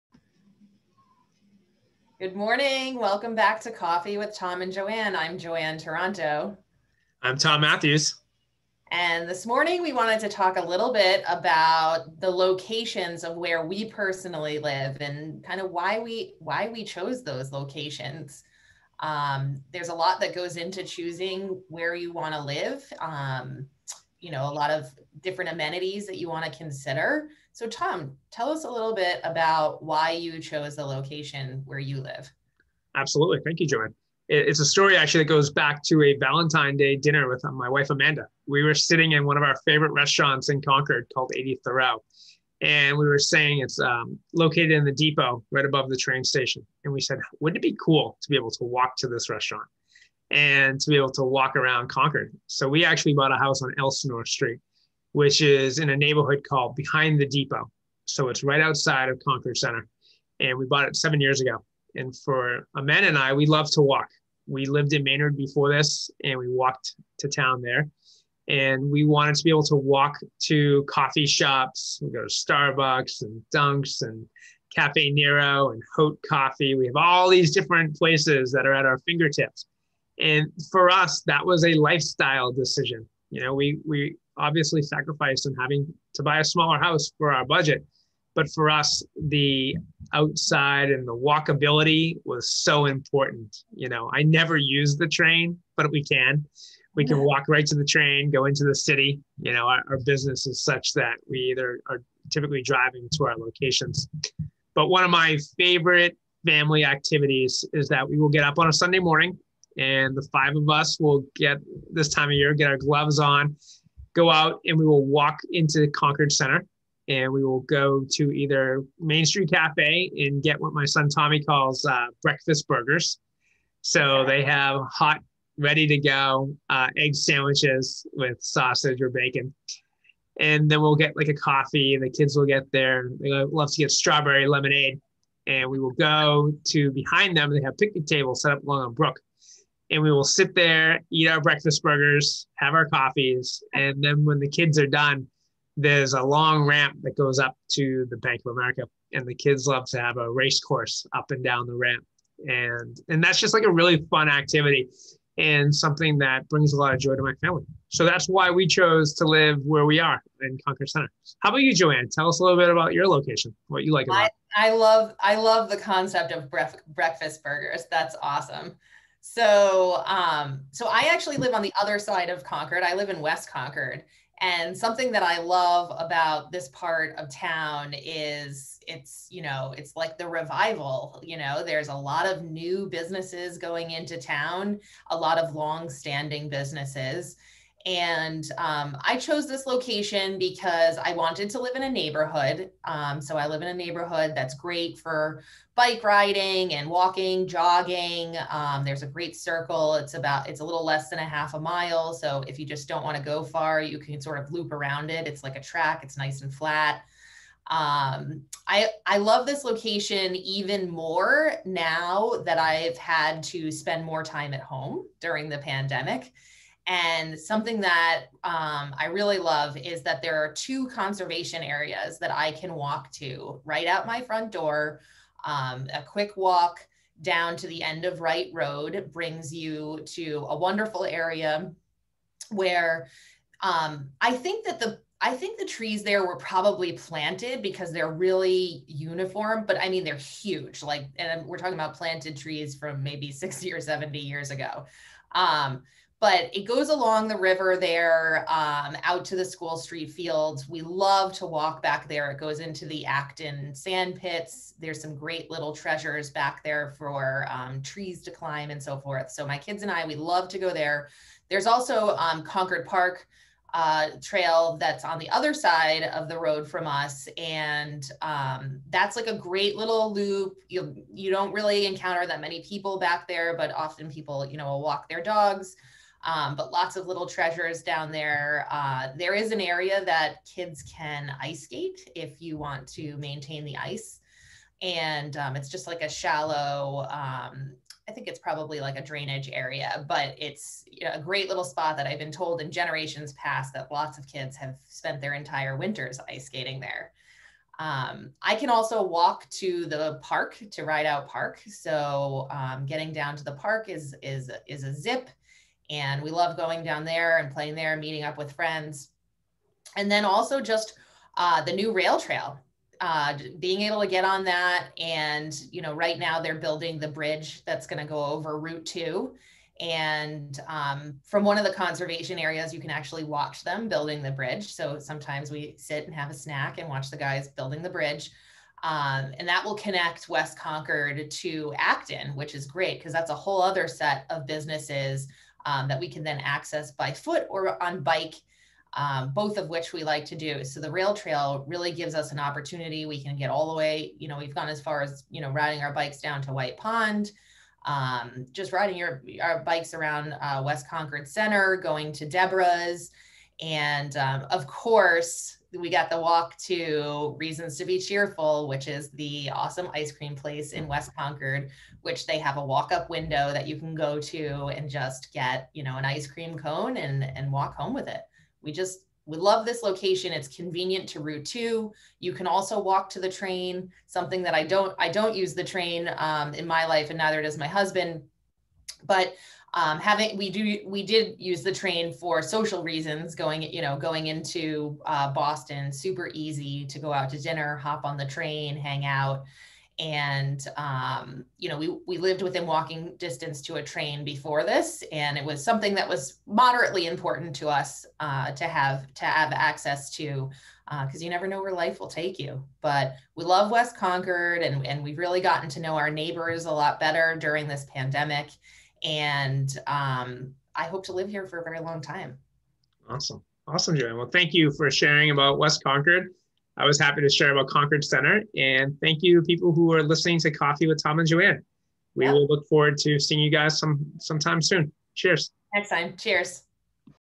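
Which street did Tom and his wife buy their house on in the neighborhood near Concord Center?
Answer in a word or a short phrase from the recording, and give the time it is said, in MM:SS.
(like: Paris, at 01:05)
Elsinore Street, at 00:53.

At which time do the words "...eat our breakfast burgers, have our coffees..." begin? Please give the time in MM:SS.
02:21.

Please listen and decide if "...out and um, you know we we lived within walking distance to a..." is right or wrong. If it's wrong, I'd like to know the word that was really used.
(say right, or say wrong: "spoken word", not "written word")
right.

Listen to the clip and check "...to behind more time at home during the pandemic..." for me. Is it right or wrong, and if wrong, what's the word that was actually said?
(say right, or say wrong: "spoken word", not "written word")
wrong: "spend", not "behind".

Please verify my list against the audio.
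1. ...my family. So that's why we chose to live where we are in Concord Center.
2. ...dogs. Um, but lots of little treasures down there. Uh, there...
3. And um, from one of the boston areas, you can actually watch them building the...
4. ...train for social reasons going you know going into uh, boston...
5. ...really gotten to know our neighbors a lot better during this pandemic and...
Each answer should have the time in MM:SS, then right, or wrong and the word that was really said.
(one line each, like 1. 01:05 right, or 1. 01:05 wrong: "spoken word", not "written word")
1. 02:37 right
2. 04:35 right
3. 05:19 wrong: "conservation", not "boston"
4. 06:21 right
5. 06:45 right.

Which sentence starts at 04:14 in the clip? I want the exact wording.
There's some great little treasures back there for um, trees to climb and so forth.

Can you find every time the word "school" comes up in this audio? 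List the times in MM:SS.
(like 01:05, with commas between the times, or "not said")
04:09.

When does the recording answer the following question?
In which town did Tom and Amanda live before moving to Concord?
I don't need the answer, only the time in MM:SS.
01:05.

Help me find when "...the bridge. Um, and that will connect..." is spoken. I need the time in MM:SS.
05:27.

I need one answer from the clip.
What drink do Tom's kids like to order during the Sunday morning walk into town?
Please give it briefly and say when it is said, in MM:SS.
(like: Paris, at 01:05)
strawberry lemonade, at 02:13.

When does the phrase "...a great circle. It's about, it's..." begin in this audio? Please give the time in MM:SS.
03:19.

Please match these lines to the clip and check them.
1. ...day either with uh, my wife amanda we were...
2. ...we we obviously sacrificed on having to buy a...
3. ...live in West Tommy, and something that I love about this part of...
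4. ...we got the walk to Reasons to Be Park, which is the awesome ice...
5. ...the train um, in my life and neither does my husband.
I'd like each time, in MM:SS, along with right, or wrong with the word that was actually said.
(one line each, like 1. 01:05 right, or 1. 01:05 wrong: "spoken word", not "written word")
1. 00:36 wrong: "dinner", not "either"
2. 01:23 right
3. 02:52 wrong: "Concord", not "Tommy"
4. 05:55 wrong: "Cheerful", not "Park"
5. 06:15 right.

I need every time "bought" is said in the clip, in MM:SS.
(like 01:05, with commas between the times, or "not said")
00:53, 01:00.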